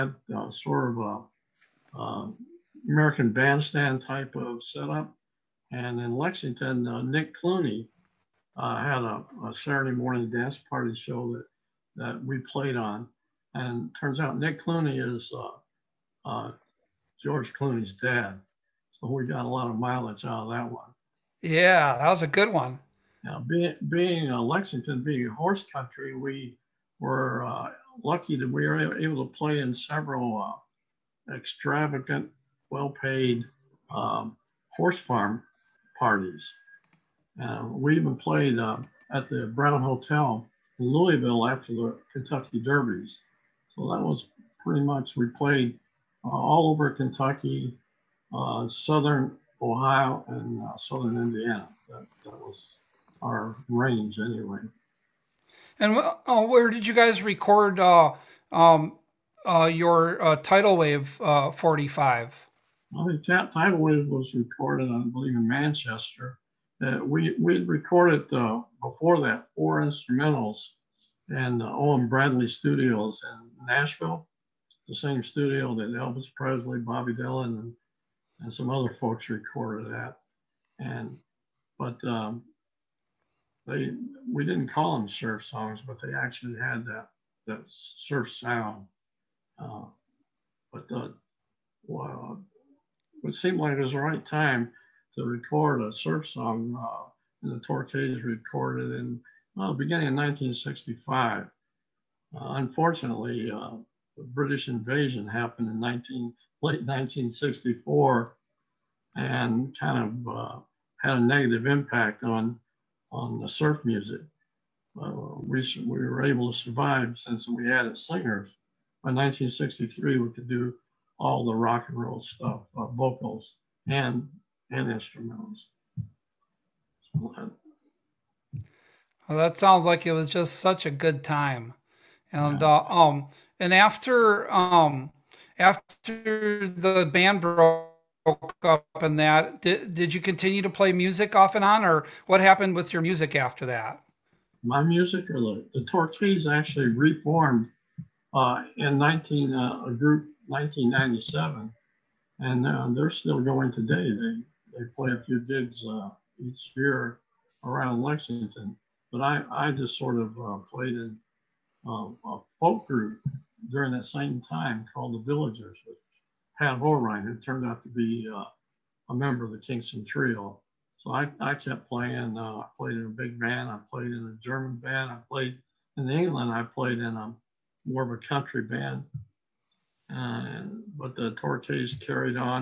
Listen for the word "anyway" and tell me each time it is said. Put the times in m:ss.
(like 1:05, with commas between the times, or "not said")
0:54.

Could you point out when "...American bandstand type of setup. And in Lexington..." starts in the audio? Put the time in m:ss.
0:02.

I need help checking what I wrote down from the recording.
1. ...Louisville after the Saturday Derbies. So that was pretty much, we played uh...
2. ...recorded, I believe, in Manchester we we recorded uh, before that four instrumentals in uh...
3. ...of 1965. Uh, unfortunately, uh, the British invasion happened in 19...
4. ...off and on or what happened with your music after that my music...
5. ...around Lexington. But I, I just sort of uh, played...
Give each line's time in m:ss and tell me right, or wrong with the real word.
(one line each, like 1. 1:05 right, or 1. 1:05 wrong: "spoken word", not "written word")
1. 0:40 wrong: "Kentucky", not "Saturday"
2. 1:04 right
3. 1:40 right
4. 2:21 right
5. 2:37 right.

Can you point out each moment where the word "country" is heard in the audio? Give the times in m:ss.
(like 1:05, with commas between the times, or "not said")
0:25, 2:58.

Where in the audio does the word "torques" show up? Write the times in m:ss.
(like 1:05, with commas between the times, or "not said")
1:37, 2:25.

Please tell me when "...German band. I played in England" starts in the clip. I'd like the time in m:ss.
2:54.